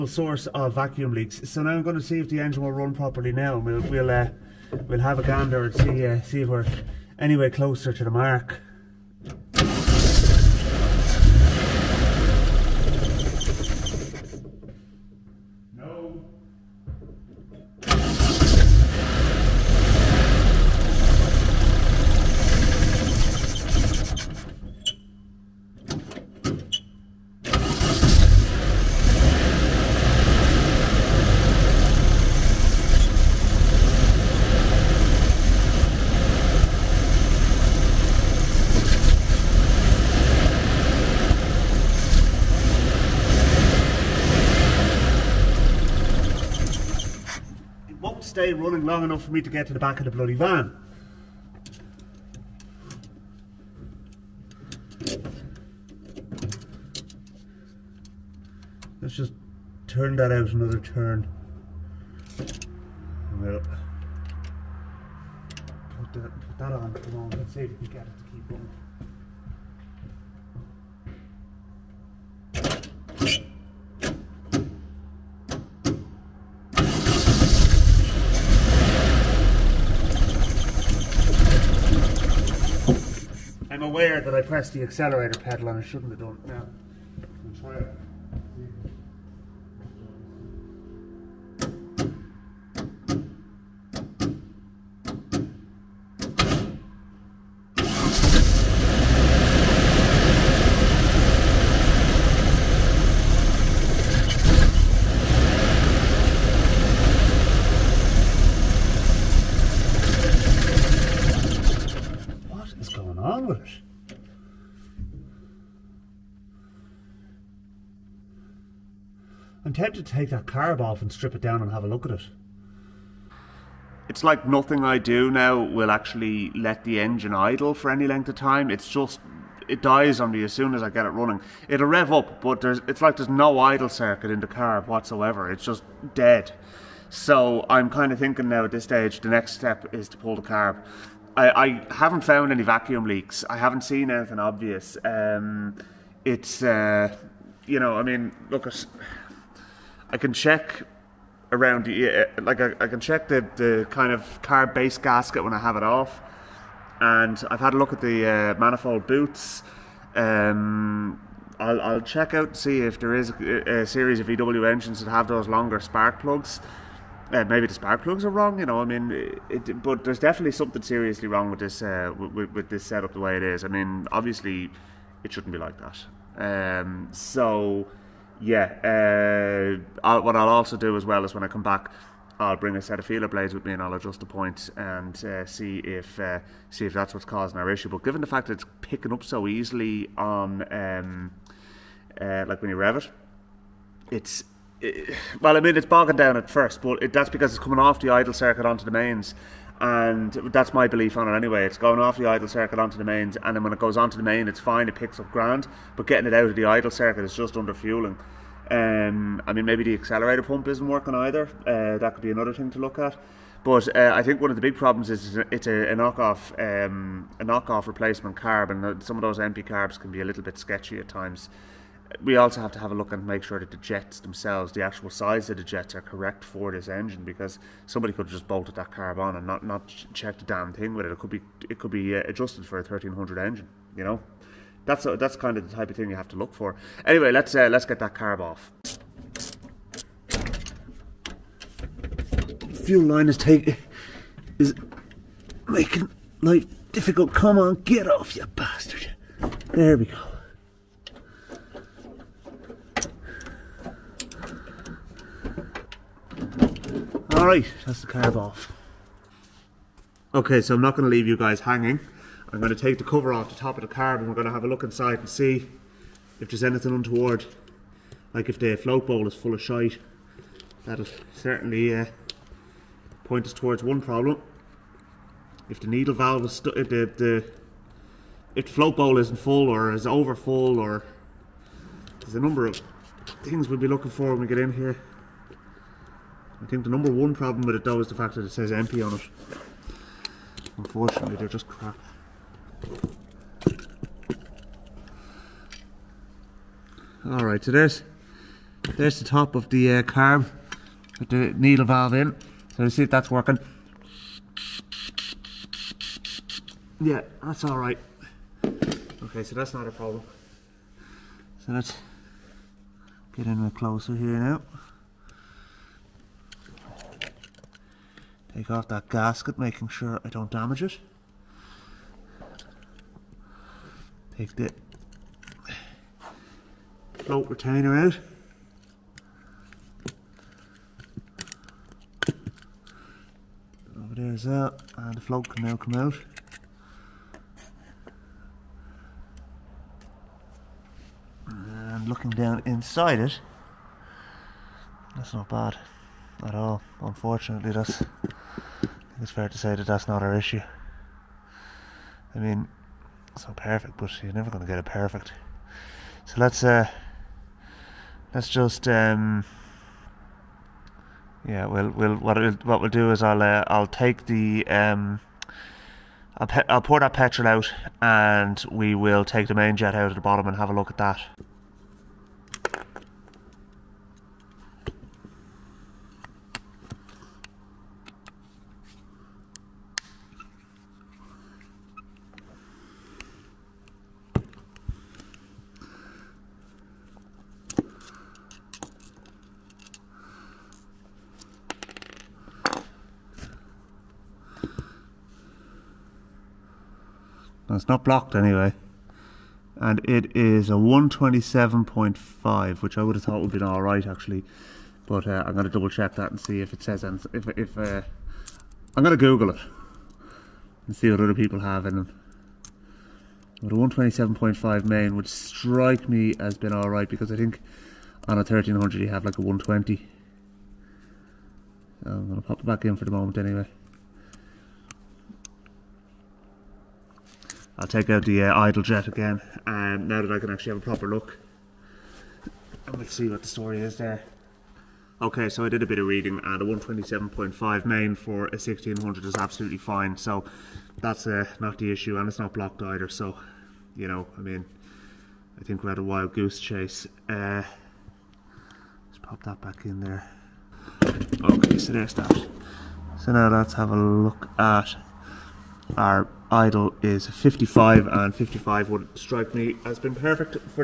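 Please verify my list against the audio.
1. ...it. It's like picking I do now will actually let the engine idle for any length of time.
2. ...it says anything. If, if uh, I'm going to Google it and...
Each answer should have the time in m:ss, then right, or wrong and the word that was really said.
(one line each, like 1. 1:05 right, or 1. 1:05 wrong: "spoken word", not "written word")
1. 2:02 wrong: "nothing", not "picking"
2. 6:46 right.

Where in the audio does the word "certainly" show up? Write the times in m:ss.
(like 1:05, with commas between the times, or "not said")
4:31.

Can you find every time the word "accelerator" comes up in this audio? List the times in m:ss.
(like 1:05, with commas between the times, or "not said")
1:24, 3:29.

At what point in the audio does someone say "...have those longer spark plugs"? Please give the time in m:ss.
2:45.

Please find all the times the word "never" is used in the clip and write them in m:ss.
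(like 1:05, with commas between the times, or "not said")
5:54.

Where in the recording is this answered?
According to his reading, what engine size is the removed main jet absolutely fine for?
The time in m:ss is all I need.
7:18.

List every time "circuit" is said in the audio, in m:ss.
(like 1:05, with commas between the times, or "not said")
2:13, 3:18, 3:22, 3:26.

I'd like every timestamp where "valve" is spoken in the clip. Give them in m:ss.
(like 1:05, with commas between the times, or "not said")
4:36, 5:01.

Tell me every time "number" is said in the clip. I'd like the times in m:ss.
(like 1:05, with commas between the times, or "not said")
4:42, 4:46.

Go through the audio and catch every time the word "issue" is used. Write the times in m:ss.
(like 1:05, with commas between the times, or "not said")
3:07, 5:50, 7:21.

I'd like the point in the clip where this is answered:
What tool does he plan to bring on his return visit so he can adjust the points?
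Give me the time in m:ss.
3:03.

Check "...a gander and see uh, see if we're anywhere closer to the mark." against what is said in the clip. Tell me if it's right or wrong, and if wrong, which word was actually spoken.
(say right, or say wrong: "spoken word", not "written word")
right.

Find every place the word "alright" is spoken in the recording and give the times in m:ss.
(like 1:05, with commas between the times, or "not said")
4:17, 6:56.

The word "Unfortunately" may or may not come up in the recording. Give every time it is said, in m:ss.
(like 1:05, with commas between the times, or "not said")
4:50, 5:47.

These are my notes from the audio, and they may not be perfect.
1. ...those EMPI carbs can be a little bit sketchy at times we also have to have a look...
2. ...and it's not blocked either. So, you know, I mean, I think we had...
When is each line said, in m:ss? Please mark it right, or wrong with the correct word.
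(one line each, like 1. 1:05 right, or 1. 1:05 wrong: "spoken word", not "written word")
1. 3:39 right
2. 7:22 right.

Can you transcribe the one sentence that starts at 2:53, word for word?
I mean, obviously, it shouldn't be like that.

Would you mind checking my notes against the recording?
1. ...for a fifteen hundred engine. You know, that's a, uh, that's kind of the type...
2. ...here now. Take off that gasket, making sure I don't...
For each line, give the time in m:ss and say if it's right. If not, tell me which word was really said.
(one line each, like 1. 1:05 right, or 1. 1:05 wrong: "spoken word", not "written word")
1. 3:52 wrong: "thirteen", not "fifteen"
2. 5:14 right.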